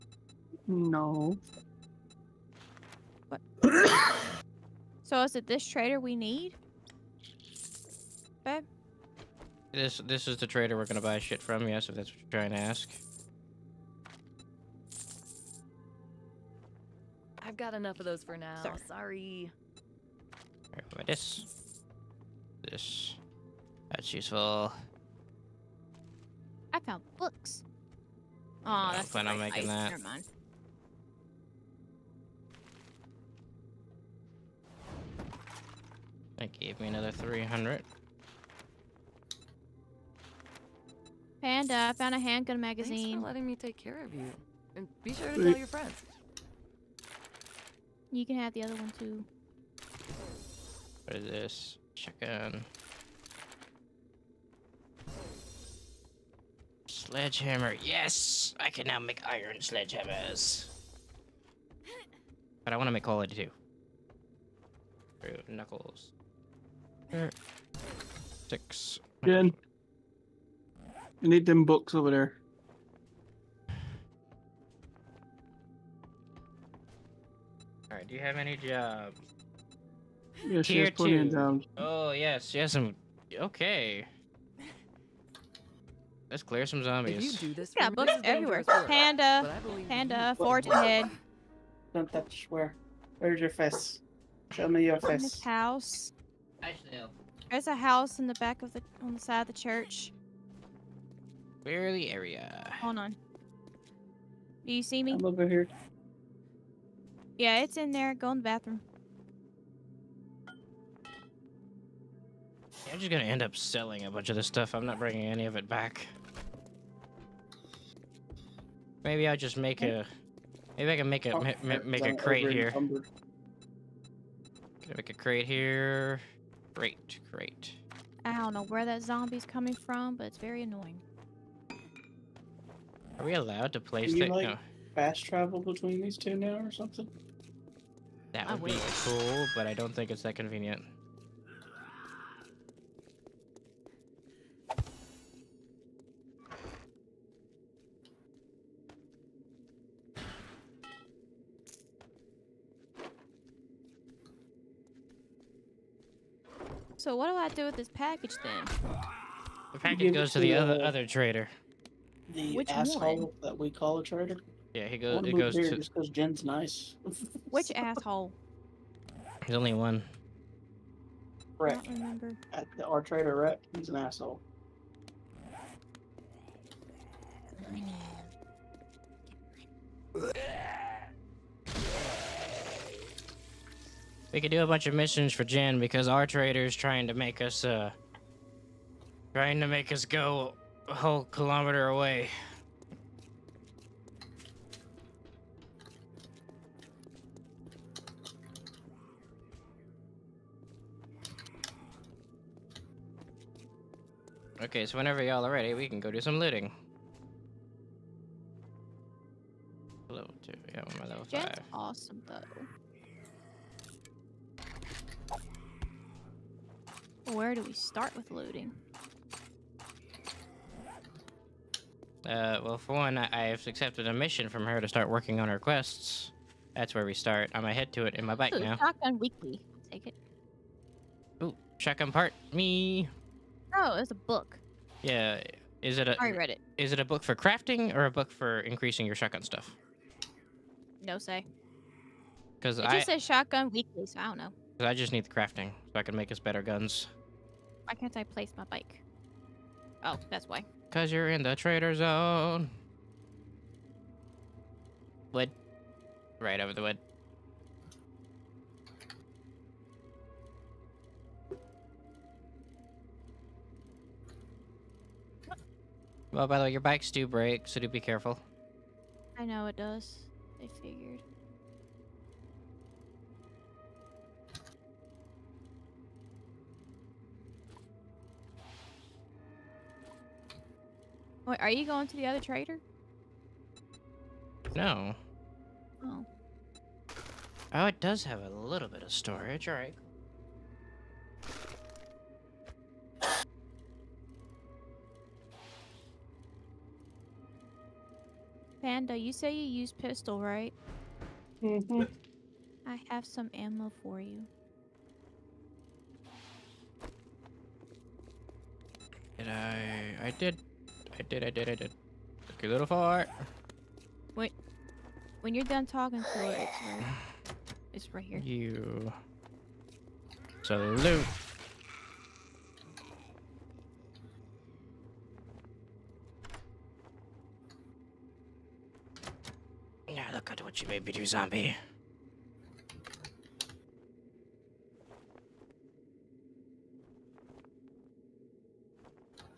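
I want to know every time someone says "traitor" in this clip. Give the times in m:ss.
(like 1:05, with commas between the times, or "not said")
2:44, 2:53.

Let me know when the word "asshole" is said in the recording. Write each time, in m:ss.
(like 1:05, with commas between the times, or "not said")
2:42, 2:47, 2:53.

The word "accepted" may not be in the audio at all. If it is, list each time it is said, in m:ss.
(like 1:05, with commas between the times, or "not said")
3:43.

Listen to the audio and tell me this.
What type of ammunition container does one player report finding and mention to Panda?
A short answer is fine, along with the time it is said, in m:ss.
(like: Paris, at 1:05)
Handgun magazine, at 0:42.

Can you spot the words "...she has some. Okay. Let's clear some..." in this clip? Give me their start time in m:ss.
1:22.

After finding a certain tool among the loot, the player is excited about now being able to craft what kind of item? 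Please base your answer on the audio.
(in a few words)
Iron sledgehammers.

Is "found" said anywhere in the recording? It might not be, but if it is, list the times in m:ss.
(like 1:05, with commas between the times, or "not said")
0:26, 0:41.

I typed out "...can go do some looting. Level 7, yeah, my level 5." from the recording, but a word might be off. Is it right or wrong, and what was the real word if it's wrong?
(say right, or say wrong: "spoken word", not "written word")
wrong: "2", not "7".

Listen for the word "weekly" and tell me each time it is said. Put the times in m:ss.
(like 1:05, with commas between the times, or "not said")
3:49, 4:03.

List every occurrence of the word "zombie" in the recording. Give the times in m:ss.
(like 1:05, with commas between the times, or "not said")
1:26, 2:09, 5:31.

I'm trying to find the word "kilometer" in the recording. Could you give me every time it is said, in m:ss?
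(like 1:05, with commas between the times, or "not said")
3:11.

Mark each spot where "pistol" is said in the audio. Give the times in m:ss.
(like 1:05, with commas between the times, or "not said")
4:59.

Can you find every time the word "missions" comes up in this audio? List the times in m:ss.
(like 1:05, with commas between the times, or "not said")
3:04, 3:44.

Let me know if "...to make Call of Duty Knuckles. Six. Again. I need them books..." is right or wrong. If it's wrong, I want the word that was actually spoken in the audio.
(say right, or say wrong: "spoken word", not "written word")
right.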